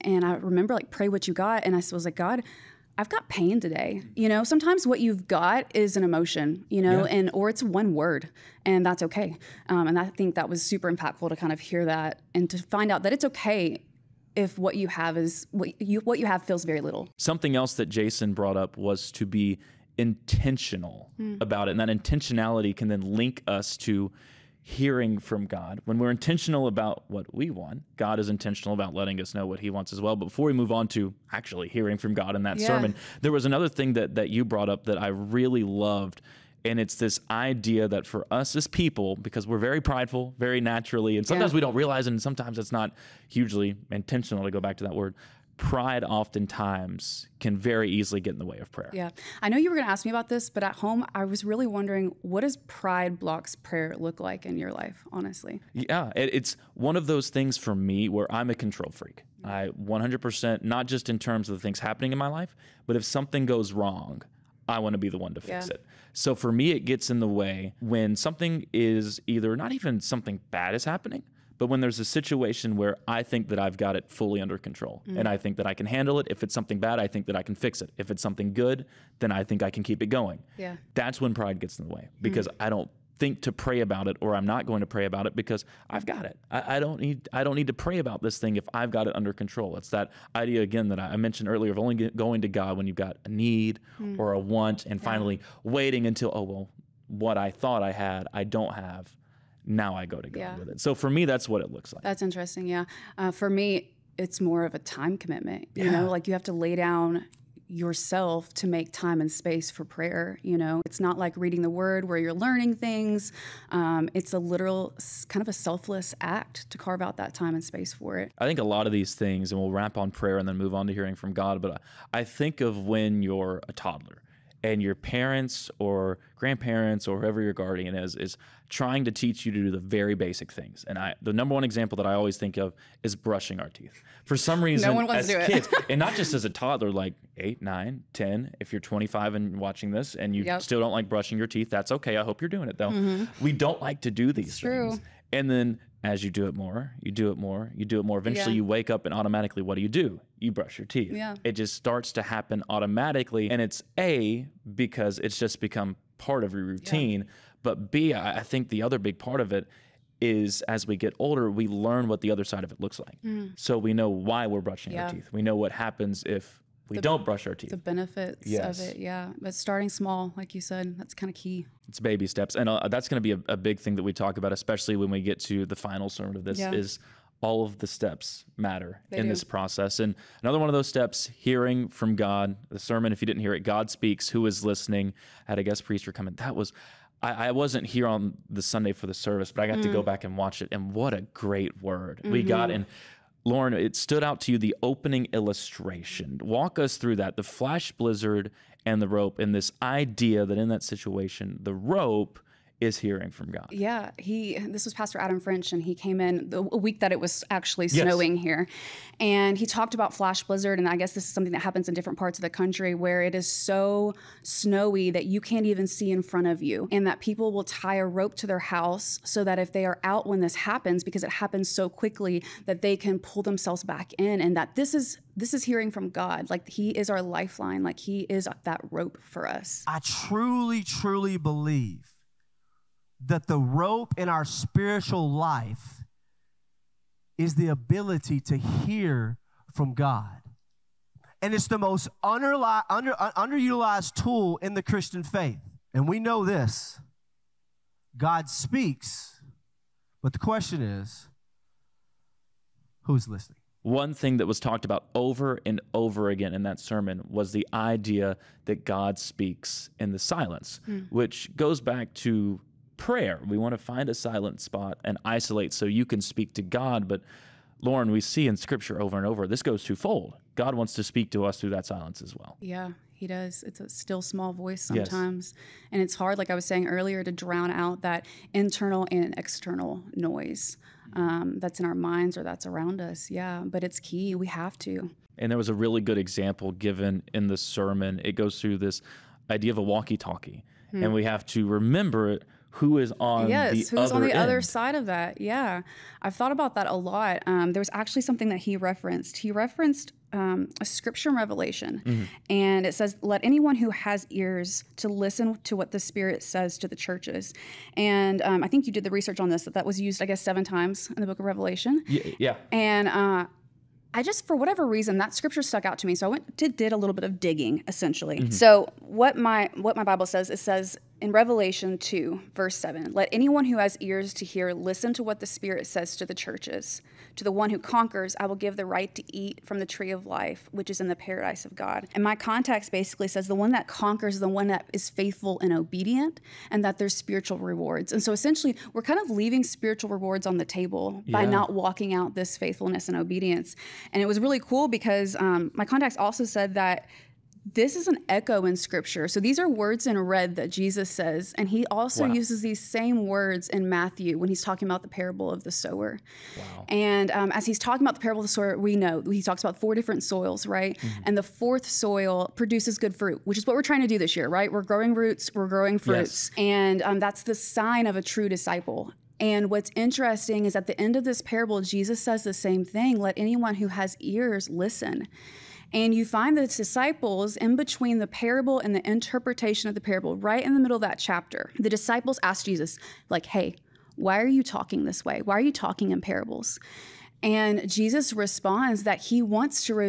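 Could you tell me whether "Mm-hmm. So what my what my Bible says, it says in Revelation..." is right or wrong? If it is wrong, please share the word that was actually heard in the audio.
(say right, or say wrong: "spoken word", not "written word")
right.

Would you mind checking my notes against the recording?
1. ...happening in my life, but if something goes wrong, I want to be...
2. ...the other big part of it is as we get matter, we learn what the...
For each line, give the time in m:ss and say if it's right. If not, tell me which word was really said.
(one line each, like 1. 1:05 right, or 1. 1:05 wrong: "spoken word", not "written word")
1. 1:01 right
2. 2:38 wrong: "older", not "matter".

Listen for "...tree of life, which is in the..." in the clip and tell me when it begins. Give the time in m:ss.
5:29.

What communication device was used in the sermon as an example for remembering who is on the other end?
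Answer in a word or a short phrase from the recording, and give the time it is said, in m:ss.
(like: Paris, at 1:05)
Walkie talkie, at 4:49.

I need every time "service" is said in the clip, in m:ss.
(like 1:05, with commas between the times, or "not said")
3:09.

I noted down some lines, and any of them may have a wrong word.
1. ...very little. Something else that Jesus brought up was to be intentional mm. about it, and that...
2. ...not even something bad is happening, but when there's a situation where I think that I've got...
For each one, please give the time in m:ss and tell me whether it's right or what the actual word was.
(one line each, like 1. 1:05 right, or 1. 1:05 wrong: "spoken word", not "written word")
1. 0:16 wrong: "Jason", not "Jesus"
2. 1:09 right.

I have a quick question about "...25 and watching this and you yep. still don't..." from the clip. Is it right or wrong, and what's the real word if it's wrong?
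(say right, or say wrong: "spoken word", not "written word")
right.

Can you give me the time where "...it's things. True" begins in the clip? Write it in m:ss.
2:24.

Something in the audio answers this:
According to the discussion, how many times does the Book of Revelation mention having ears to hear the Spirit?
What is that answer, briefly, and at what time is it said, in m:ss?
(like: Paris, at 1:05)
7, at 5:10.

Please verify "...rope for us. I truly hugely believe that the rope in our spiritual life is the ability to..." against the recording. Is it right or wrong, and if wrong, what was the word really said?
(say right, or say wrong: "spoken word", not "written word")
wrong: "truly", not "hugely".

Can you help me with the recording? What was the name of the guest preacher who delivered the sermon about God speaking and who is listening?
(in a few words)
Adam French.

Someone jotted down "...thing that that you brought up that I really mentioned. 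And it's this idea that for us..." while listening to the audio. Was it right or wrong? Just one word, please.
wrong.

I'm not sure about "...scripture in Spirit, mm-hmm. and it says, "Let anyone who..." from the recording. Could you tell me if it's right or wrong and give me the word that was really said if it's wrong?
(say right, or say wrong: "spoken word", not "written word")
wrong: "Revelation", not "Spirit".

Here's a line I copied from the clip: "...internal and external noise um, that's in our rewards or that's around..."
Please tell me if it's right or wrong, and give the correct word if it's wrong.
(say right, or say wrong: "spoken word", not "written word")
wrong: "minds", not "rewards".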